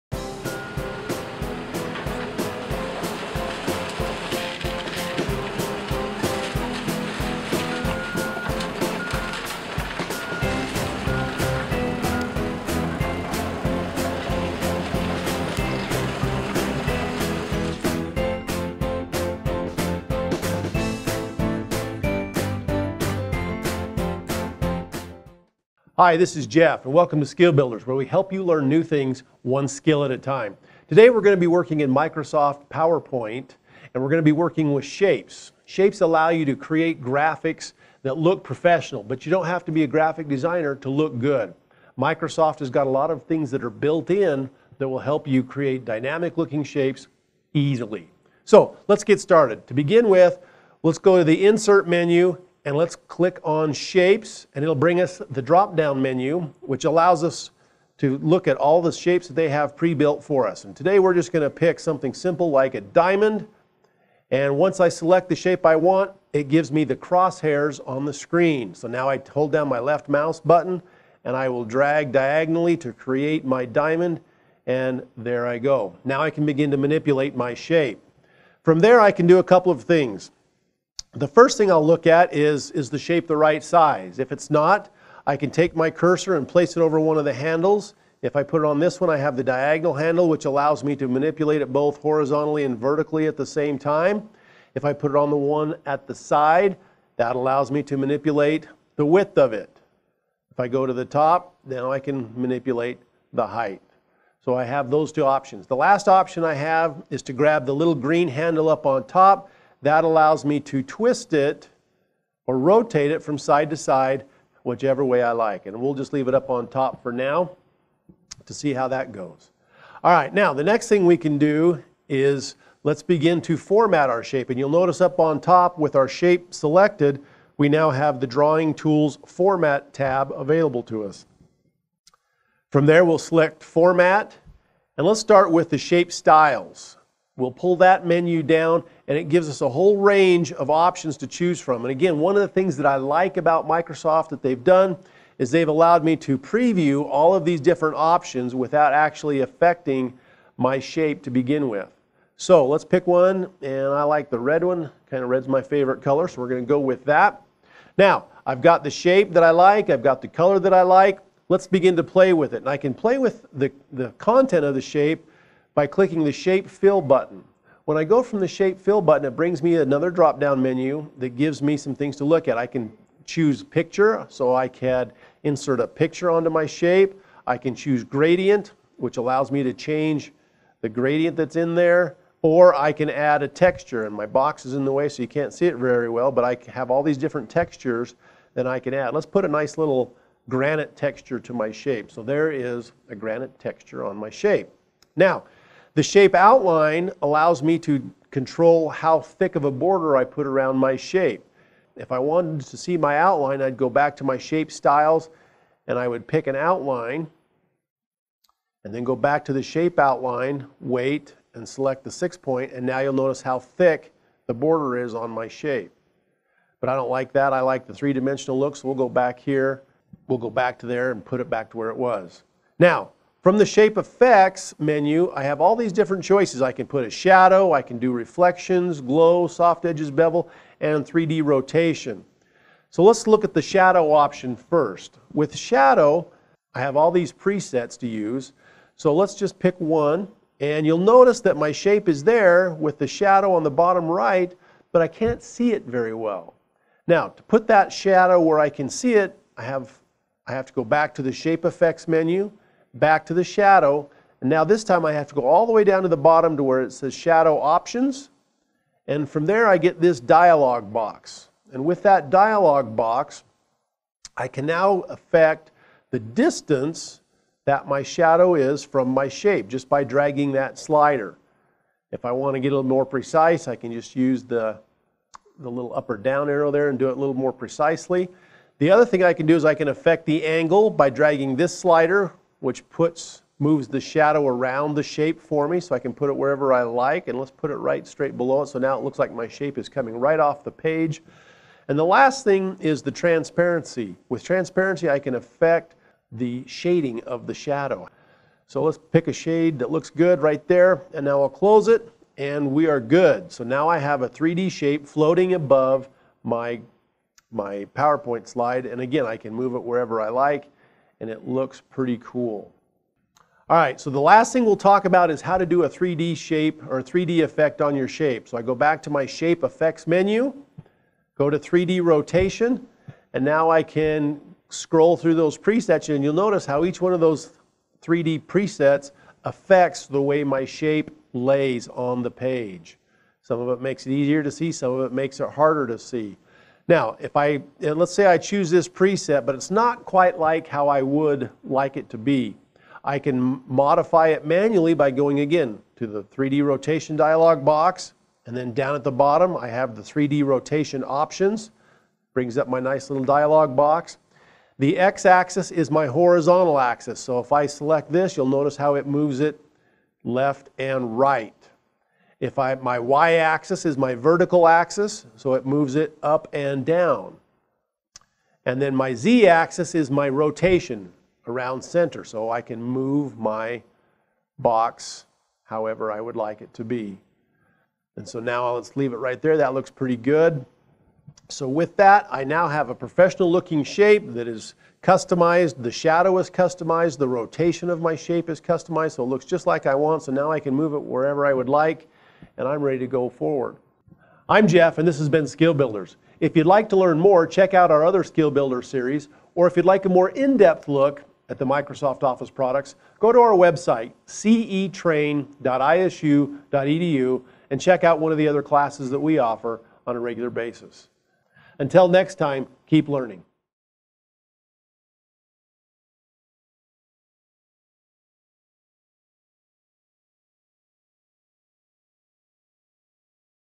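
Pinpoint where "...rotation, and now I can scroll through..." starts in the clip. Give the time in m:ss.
5:22.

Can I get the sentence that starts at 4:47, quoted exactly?
And let's put it right straight below it.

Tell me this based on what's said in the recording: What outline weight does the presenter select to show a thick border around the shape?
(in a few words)
6 point.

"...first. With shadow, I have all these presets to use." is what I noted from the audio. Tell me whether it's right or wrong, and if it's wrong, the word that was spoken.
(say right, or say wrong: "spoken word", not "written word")
right.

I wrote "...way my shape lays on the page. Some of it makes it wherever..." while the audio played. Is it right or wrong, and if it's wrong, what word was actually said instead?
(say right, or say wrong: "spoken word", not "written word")
wrong: "easier", not "wherever".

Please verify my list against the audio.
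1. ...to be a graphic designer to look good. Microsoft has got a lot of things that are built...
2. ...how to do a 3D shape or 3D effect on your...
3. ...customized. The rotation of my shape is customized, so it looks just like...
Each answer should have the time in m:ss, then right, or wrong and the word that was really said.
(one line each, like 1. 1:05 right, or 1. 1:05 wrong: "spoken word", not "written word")
1. 0:39 right
2. 5:15 right
3. 6:26 right.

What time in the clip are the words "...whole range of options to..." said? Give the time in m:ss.
2:19.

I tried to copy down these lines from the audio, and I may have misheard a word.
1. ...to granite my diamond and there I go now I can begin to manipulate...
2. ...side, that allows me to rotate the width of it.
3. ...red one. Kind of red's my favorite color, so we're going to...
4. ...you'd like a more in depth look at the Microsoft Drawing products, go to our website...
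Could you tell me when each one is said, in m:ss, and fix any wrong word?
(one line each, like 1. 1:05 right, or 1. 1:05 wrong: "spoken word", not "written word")
1. 1:12 wrong: "create", not "granite"
2. 1:36 wrong: "manipulate", not "rotate"
3. 2:34 right
4. 6:39 wrong: "Office", not "Drawing".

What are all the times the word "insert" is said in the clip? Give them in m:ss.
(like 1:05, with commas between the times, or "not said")
0:51, 2:55.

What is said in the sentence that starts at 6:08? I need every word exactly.
And then my z-axis is my rotation around center, so I can move my box however I would like it to be.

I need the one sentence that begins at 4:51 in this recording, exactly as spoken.
And the last thing is the transparency.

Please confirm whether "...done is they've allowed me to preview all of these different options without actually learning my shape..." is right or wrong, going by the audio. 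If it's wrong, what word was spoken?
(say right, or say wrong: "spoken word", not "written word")
wrong: "affecting", not "learning".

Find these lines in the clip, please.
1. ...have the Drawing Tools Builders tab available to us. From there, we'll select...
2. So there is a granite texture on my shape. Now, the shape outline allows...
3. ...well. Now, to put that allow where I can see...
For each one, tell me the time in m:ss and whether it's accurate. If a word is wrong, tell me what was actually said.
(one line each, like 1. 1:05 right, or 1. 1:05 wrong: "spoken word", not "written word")
1. 2:07 wrong: "Format", not "Builders"
2. 3:12 right
3. 4:06 wrong: "shadow", not "allow".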